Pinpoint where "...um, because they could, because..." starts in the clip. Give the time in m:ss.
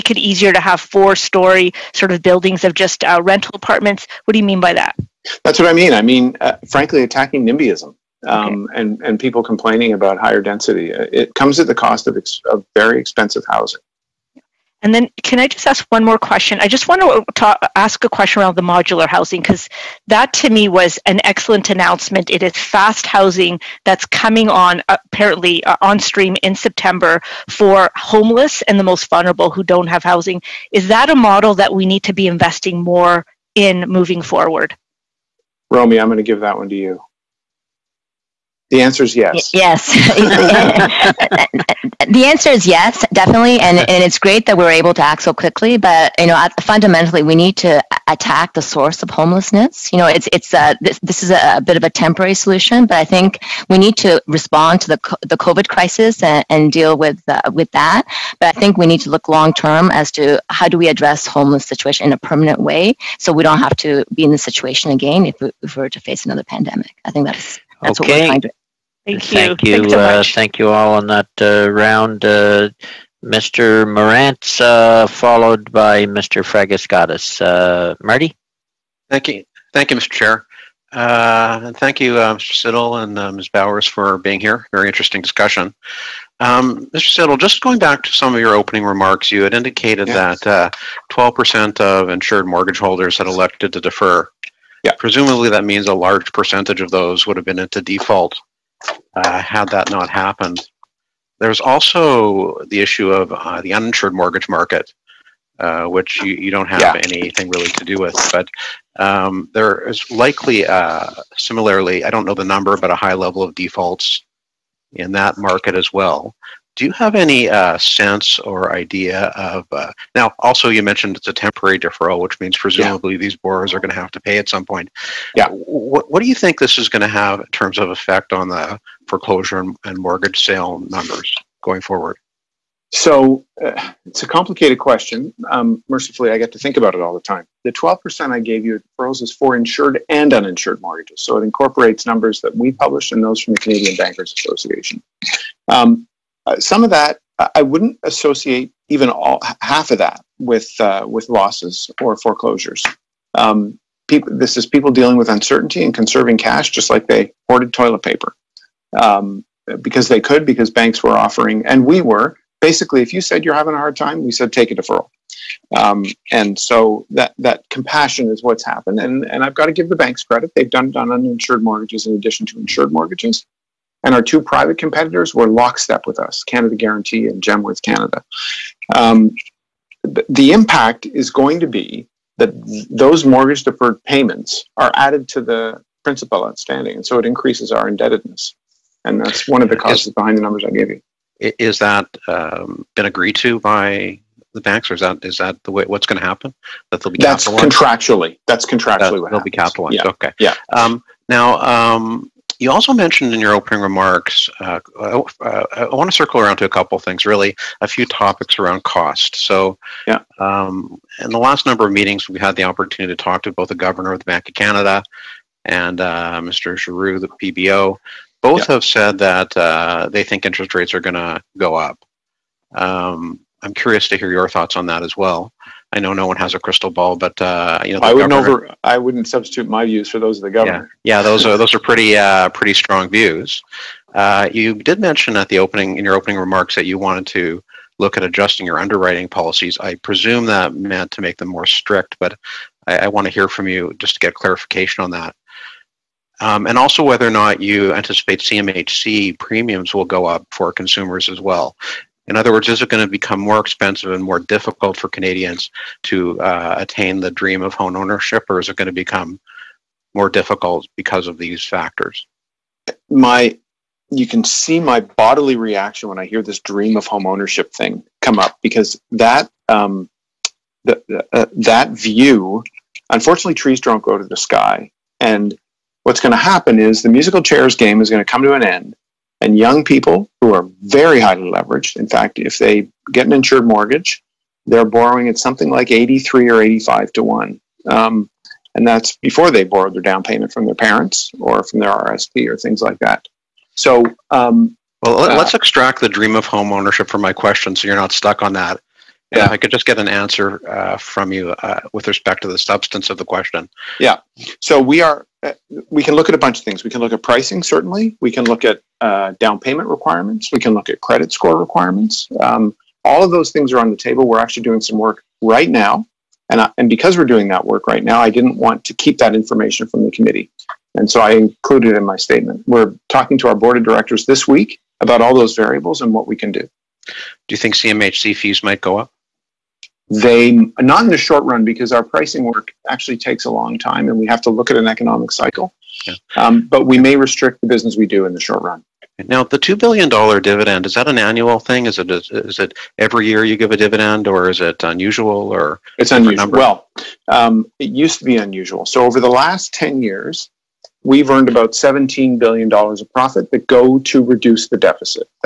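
2:38.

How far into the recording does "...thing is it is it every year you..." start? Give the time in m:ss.
5:41.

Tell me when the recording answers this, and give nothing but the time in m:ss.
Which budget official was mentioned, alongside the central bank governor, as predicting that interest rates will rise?
3:36.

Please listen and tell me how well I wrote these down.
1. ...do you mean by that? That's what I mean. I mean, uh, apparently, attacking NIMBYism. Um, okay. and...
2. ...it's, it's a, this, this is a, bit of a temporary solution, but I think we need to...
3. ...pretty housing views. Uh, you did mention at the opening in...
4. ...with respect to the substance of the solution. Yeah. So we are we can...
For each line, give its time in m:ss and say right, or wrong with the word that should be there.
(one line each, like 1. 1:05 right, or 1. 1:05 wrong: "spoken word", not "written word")
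1. 0:04 wrong: "frankly", not "apparently"
2. 0:50 right
3. 3:52 wrong: "strong", not "housing"
4. 5:01 wrong: "question", not "solution".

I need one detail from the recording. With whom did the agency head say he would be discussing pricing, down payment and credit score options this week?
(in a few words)
board of directors.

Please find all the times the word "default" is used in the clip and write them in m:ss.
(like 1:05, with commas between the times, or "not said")
1:37, 1:53.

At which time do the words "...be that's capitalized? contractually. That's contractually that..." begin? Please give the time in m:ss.
3:17.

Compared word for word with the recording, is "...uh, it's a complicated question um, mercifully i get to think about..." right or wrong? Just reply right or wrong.
right.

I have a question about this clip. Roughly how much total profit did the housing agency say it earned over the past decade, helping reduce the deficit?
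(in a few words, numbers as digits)
$17 billion.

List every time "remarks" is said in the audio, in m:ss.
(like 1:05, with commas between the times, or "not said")
1:28, 3:23, 3:56.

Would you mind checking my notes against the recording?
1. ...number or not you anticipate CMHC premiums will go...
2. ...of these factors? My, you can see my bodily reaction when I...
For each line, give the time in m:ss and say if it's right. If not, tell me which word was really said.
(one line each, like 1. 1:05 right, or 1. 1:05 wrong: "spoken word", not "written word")
1. 4:07 wrong: "whether", not "number"
2. 4:21 right.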